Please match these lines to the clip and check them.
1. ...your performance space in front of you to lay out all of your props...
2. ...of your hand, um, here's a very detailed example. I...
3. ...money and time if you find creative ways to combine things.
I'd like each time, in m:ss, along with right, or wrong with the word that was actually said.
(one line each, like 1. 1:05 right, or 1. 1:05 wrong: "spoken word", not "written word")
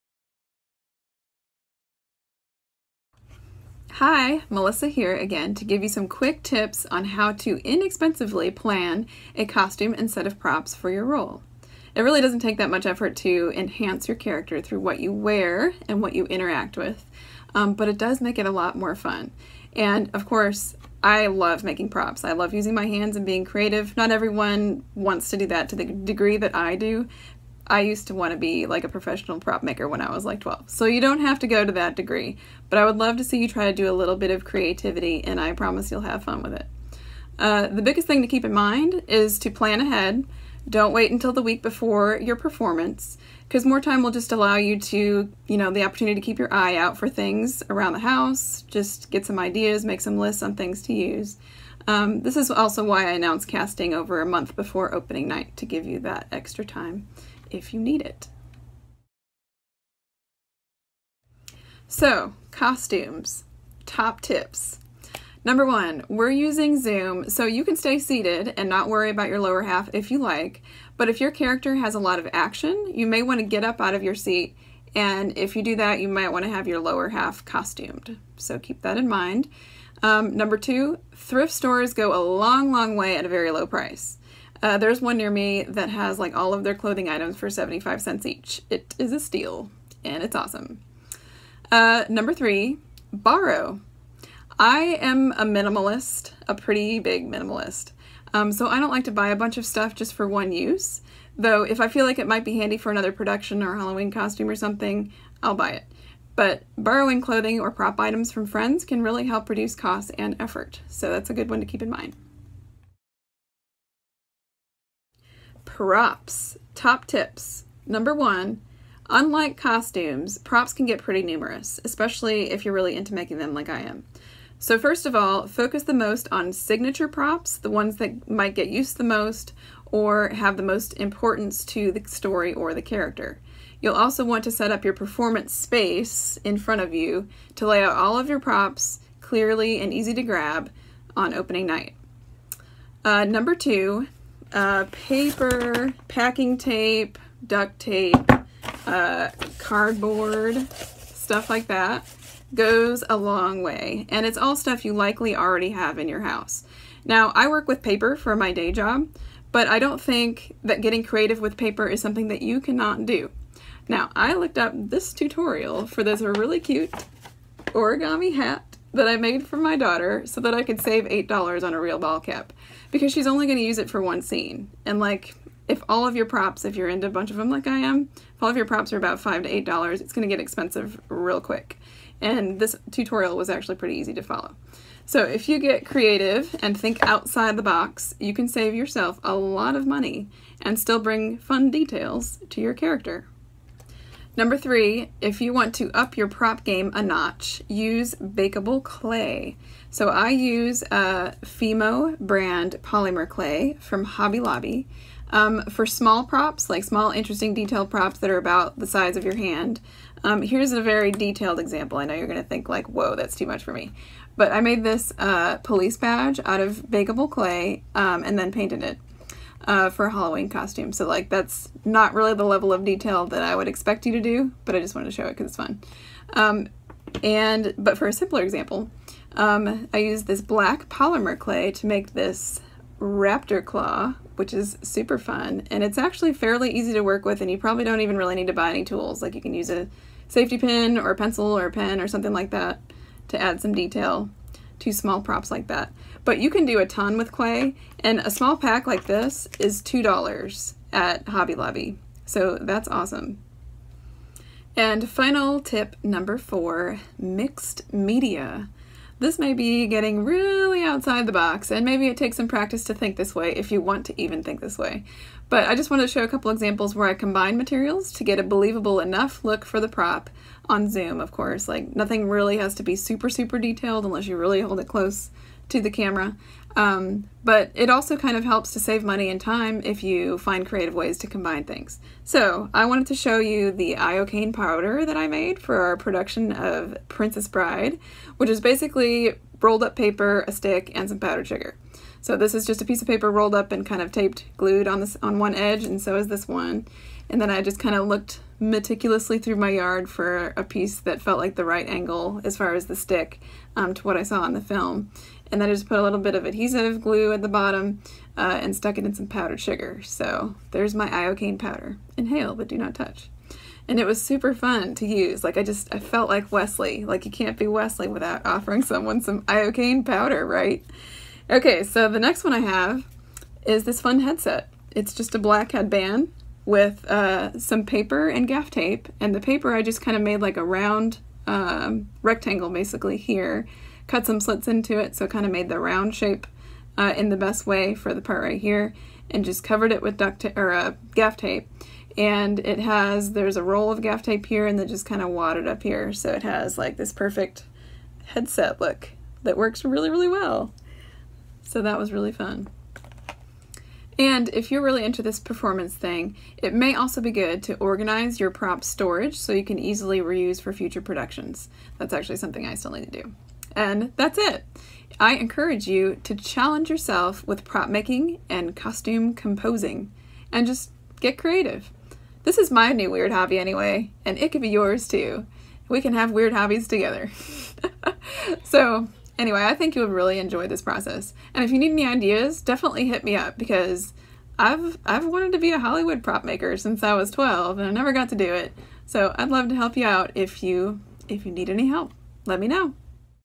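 1. 2:14 right
2. 3:29 right
3. 4:39 right.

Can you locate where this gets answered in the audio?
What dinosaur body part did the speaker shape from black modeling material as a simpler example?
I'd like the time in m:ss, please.
3:53.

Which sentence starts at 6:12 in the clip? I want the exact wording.
This is my new weird hobby anyway, and it could be yours too.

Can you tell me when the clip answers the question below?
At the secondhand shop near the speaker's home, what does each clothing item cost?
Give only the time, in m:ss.
1:27.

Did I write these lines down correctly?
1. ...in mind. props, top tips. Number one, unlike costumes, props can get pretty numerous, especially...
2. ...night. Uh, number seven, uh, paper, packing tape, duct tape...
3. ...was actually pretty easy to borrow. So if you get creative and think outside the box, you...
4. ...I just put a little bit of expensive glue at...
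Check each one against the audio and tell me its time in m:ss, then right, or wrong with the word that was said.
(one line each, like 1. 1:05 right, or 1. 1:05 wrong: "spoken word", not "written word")
1. 1:51 right
2. 2:21 wrong: "two", not "seven"
3. 3:03 wrong: "follow", not "borrow"
4. 5:05 wrong: "adhesive", not "expensive".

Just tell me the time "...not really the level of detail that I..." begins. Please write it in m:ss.
3:41.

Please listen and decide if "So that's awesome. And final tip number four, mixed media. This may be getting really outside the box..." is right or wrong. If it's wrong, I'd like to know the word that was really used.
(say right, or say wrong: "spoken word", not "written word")
right.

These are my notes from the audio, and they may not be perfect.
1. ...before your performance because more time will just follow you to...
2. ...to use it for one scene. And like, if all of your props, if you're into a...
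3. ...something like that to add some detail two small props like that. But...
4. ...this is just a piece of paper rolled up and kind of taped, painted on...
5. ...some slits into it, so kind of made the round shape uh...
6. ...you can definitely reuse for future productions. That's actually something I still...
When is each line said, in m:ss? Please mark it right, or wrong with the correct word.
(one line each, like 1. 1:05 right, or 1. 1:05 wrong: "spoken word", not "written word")
1. 0:41 wrong: "allow", not "follow"
2. 2:53 right
3. 4:02 right
4. 4:52 wrong: "glued", not "painted"
5. 5:34 right
6. 5:59 wrong: "easily", not "definitely".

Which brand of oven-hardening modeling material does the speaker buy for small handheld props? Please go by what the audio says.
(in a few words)
Fimo.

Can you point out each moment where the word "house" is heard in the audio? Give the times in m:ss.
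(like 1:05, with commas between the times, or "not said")
0:47, 2:36.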